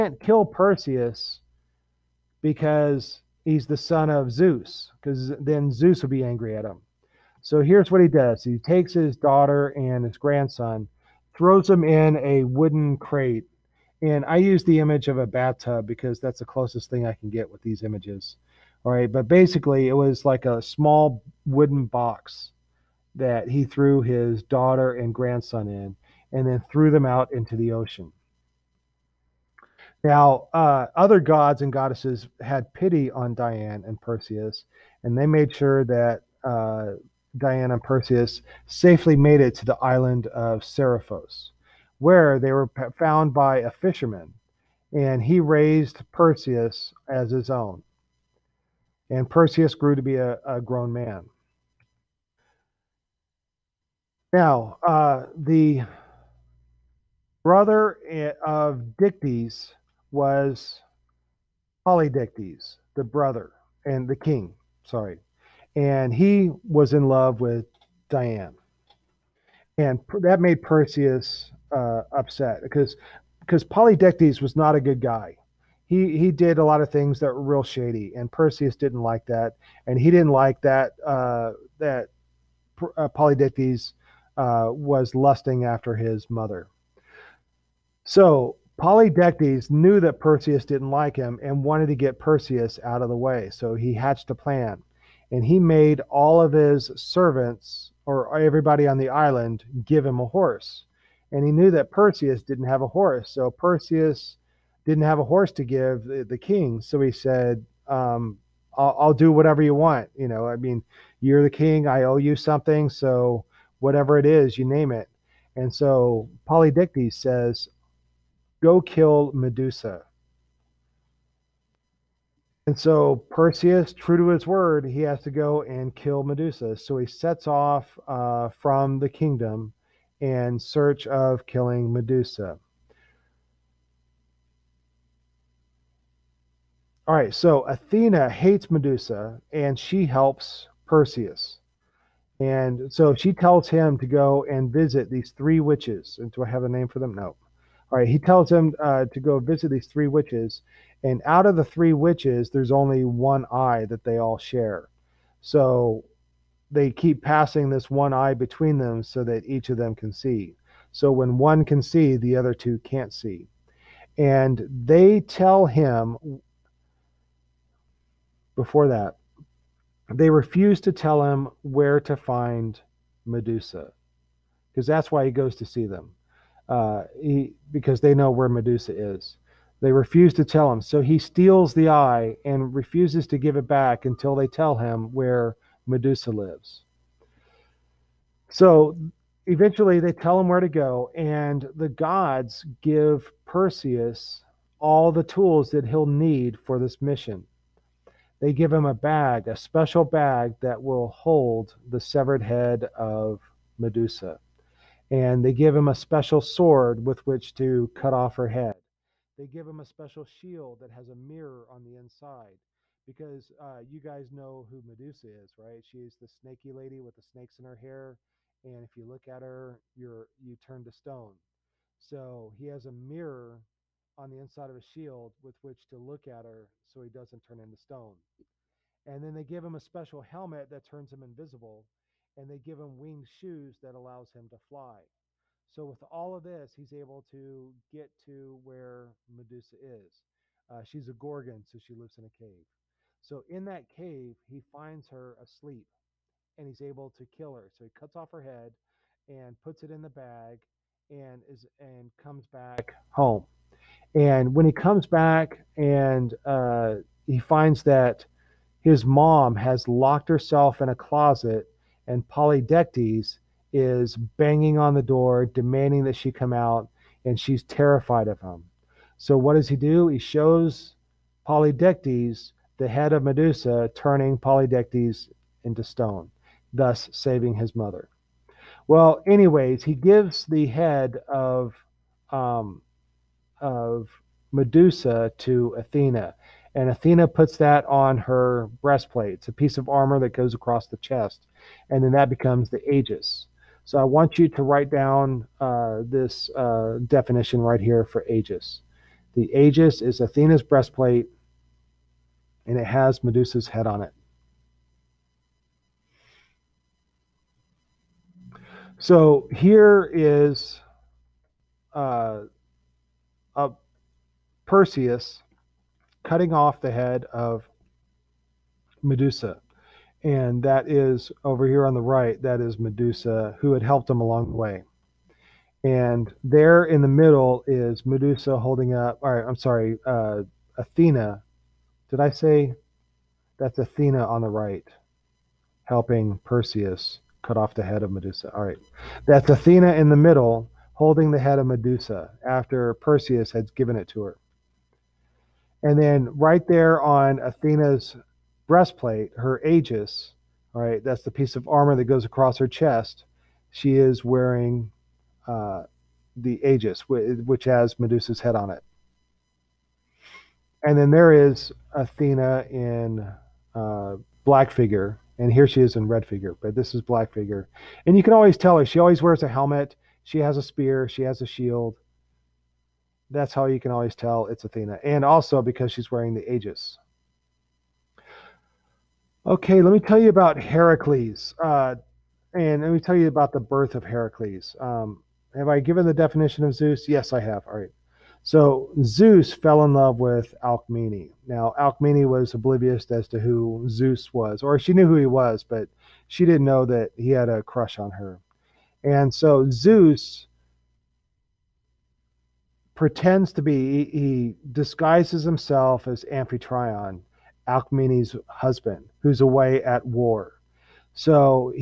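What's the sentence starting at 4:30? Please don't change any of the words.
He shows Polydectes, the head of Medusa, turning Polydectes into stone, thus saving his mother.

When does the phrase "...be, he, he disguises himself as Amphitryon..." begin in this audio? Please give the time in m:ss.
6:43.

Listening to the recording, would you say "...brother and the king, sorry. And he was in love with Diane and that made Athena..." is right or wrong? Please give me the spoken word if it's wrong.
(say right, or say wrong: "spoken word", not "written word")
wrong: "Perseus", not "Athena".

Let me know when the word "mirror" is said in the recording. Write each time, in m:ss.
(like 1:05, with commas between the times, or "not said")
3:31, 3:42.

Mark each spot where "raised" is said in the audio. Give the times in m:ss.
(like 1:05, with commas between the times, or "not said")
0:45.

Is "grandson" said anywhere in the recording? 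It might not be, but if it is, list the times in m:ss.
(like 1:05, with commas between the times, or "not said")
0:10, 0:25.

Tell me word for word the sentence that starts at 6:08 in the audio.
And you can always tell her, she always wears a helmet, she has a spear, she has a shield.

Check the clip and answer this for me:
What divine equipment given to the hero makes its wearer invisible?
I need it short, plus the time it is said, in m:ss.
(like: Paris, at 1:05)
A helmet, at 3:49.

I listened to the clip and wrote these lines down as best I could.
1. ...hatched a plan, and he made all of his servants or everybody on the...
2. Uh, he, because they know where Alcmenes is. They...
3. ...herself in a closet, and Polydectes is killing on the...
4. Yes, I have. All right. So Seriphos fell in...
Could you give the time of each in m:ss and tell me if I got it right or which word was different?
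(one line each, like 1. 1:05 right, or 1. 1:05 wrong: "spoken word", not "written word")
1. 1:33 right
2. 2:56 wrong: "Medusa", not "Alcmenes"
3. 4:20 wrong: "banging", not "killing"
4. 6:27 wrong: "Zeus", not "Seriphos".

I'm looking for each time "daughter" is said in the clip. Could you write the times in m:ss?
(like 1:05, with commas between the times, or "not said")
0:09, 0:24.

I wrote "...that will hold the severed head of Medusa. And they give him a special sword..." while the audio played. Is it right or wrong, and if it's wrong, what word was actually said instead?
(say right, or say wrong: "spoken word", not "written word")
right.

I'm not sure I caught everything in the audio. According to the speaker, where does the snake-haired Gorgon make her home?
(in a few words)
A cave.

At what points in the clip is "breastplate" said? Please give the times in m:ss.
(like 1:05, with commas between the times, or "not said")
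4:48, 5:00, 5:48.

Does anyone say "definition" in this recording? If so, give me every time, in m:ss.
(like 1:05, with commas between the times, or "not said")
4:57, 6:26.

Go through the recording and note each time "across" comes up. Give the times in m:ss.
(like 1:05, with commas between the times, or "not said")
4:50, 5:52.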